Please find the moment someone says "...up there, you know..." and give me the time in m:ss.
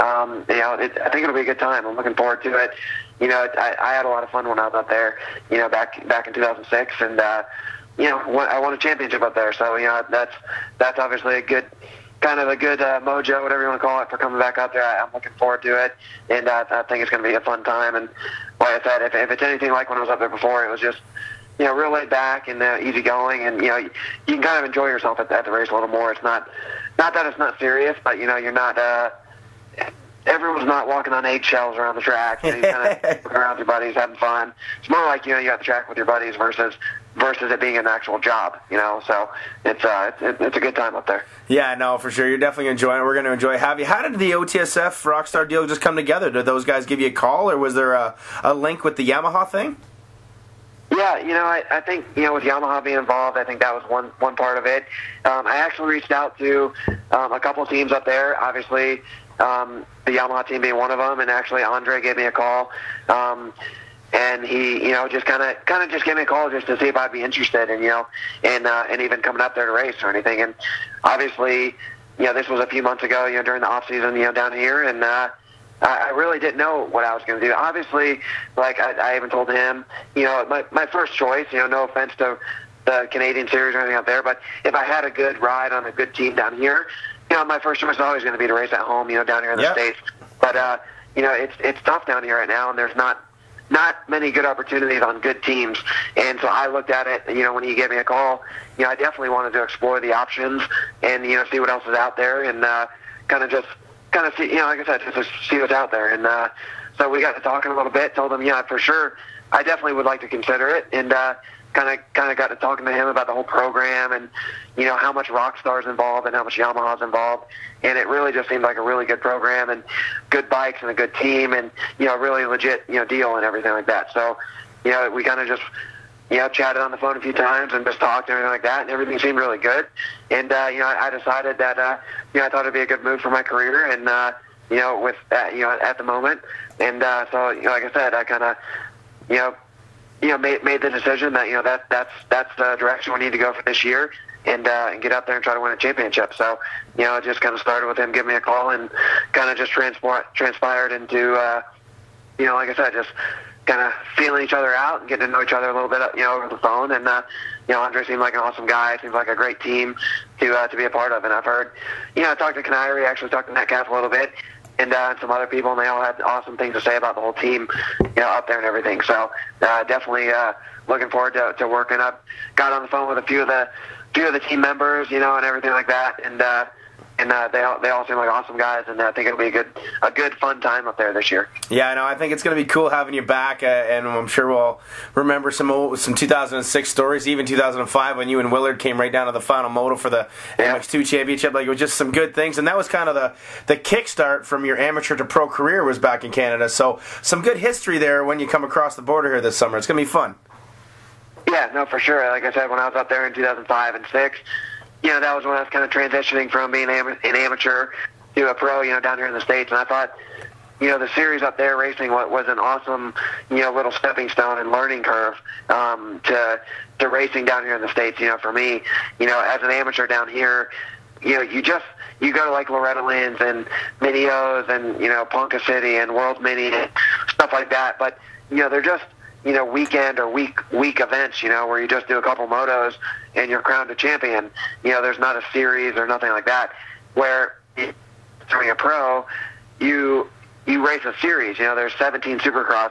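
0:04.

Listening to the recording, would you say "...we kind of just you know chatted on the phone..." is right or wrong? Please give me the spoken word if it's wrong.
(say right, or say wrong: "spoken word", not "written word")
right.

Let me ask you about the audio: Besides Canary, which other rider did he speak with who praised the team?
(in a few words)
Metcalf.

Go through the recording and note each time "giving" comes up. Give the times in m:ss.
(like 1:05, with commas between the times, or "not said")
2:28.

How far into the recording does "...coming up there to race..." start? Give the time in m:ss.
1:09.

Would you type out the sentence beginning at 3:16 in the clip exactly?
So some good history there when you come across the border here this summer.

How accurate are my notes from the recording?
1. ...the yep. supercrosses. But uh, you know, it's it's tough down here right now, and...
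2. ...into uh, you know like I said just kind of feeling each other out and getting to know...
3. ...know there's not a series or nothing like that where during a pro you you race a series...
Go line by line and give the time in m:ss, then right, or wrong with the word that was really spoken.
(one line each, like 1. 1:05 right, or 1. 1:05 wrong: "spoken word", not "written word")
1. 1:29 wrong: "states", not "supercrosses"
2. 2:30 right
3. 3:54 right.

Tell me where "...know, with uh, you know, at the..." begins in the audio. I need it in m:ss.
2:14.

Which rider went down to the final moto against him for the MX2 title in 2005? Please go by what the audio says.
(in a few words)
Willard.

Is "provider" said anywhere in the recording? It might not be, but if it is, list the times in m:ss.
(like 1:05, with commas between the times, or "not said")
not said.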